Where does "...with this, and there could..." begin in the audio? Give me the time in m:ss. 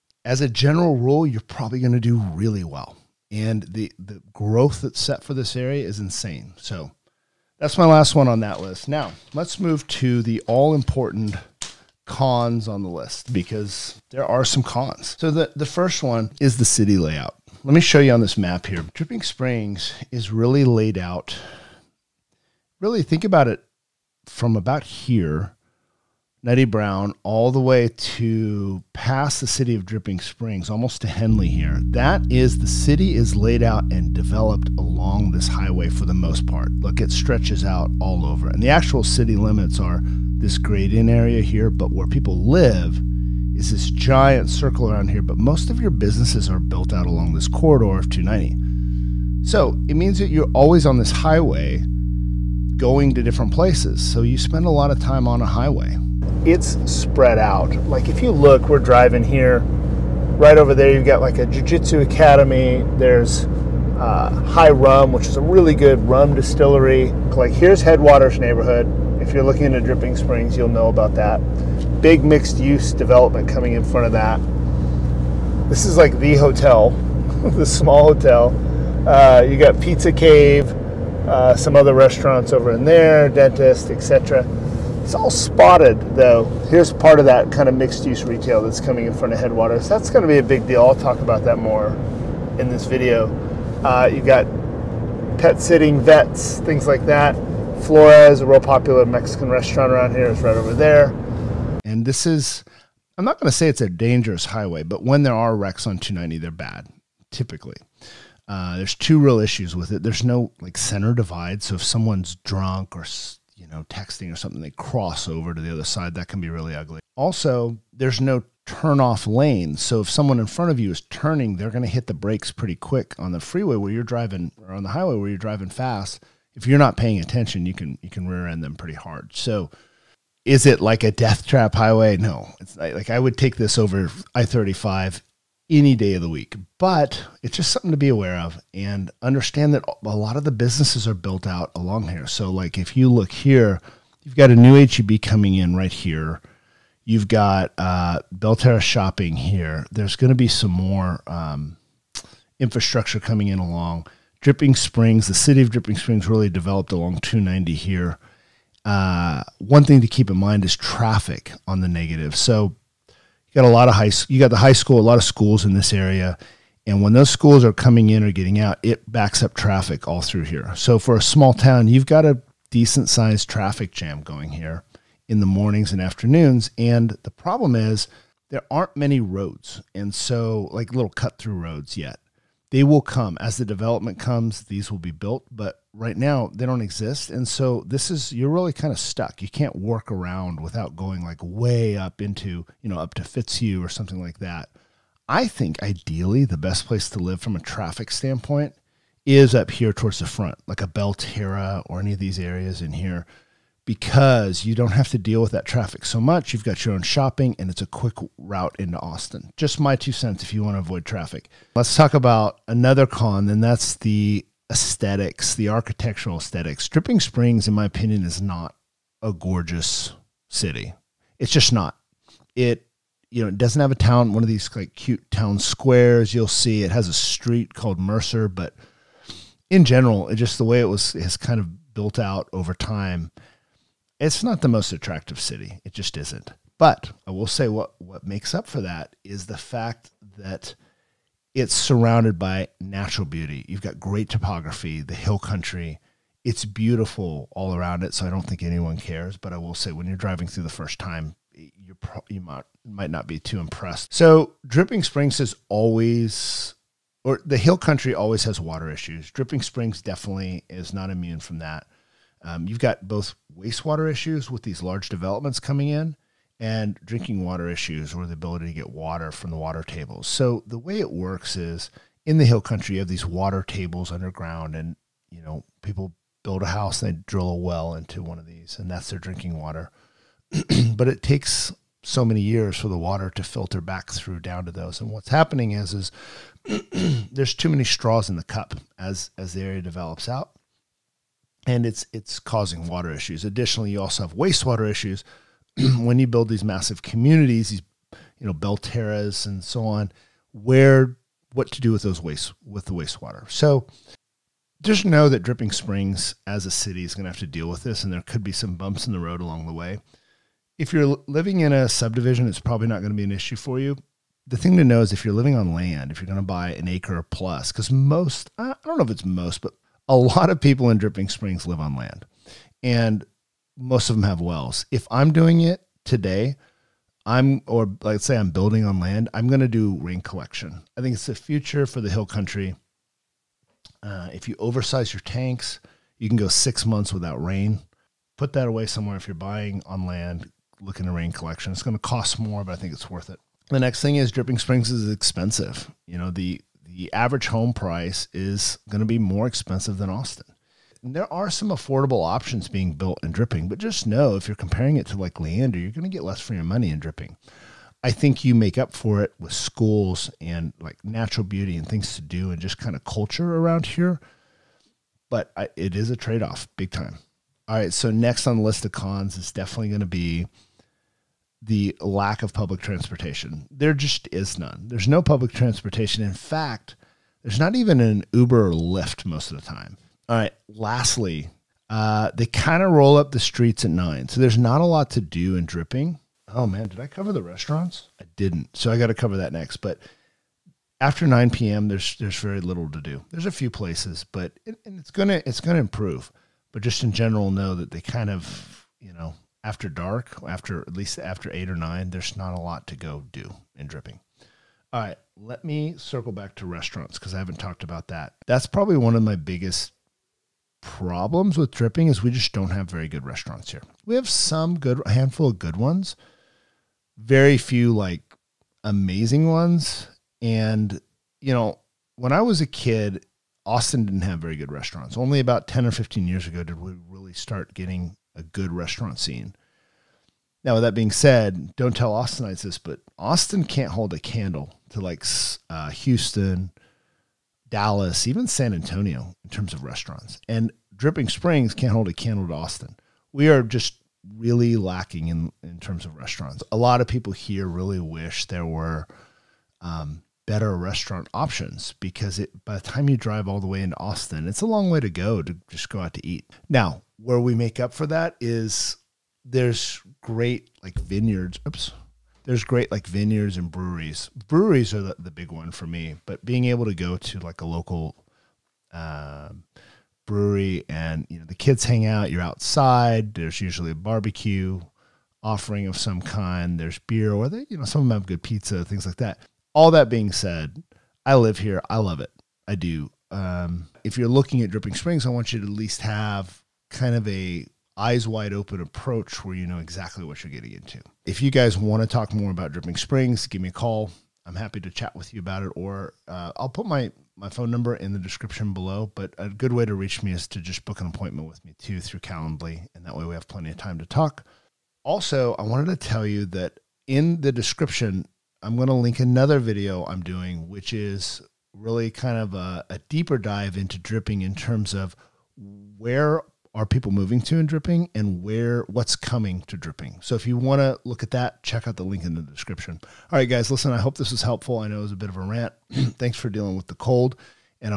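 5:07.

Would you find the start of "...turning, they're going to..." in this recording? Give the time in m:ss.
2:01.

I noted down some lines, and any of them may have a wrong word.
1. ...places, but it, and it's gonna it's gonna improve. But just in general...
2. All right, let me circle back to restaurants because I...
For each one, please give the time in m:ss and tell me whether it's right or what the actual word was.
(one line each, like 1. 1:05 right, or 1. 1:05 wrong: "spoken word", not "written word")
1. 6:33 right
2. 6:44 right.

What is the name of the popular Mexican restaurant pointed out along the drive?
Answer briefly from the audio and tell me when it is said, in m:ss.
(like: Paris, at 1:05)
Flores, at 1:37.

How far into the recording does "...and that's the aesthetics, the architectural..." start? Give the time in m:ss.
3:33.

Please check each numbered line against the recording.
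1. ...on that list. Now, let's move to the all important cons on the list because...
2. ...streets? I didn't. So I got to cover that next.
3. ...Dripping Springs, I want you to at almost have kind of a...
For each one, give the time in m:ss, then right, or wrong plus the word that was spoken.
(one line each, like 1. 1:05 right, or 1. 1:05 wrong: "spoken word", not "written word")
1. 0:08 right
2. 6:27 wrong: "restaurants", not "streets"
3. 8:04 wrong: "least", not "almost".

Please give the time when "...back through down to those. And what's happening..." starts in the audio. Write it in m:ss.
4:43.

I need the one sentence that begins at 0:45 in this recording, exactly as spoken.
But most of your businesses are built out along this corridor of 290.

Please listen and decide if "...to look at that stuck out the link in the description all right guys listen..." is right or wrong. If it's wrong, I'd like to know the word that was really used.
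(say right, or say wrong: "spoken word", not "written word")
wrong: "check", not "stuck".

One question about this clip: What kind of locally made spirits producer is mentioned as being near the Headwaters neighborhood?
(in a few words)
Rum distillery.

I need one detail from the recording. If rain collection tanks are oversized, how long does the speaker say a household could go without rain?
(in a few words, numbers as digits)
6 months.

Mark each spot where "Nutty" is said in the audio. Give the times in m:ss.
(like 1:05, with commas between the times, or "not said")
0:26.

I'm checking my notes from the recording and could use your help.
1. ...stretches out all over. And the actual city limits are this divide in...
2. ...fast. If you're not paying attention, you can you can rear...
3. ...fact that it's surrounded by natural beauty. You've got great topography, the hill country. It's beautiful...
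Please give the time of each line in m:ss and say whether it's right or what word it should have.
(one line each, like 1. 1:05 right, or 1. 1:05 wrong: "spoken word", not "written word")
1. 0:37 wrong: "grade", not "divide"
2. 2:05 right
3. 3:59 right.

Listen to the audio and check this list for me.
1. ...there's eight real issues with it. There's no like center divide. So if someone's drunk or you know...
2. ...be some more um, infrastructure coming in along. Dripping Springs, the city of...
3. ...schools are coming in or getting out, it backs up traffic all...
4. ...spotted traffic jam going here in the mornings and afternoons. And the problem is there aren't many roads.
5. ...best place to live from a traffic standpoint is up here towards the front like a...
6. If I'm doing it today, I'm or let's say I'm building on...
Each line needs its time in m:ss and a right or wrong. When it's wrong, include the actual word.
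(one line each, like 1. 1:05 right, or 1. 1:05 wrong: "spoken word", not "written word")
1. 1:48 wrong: "two", not "eight"
2. 2:30 right
3. 2:47 right
4. 2:53 wrong: "sized", not "spotted"
5. 3:16 right
6. 5:24 right.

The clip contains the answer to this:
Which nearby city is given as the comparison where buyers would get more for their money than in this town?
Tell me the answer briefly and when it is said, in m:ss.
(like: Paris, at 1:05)
Leander, at 5:55.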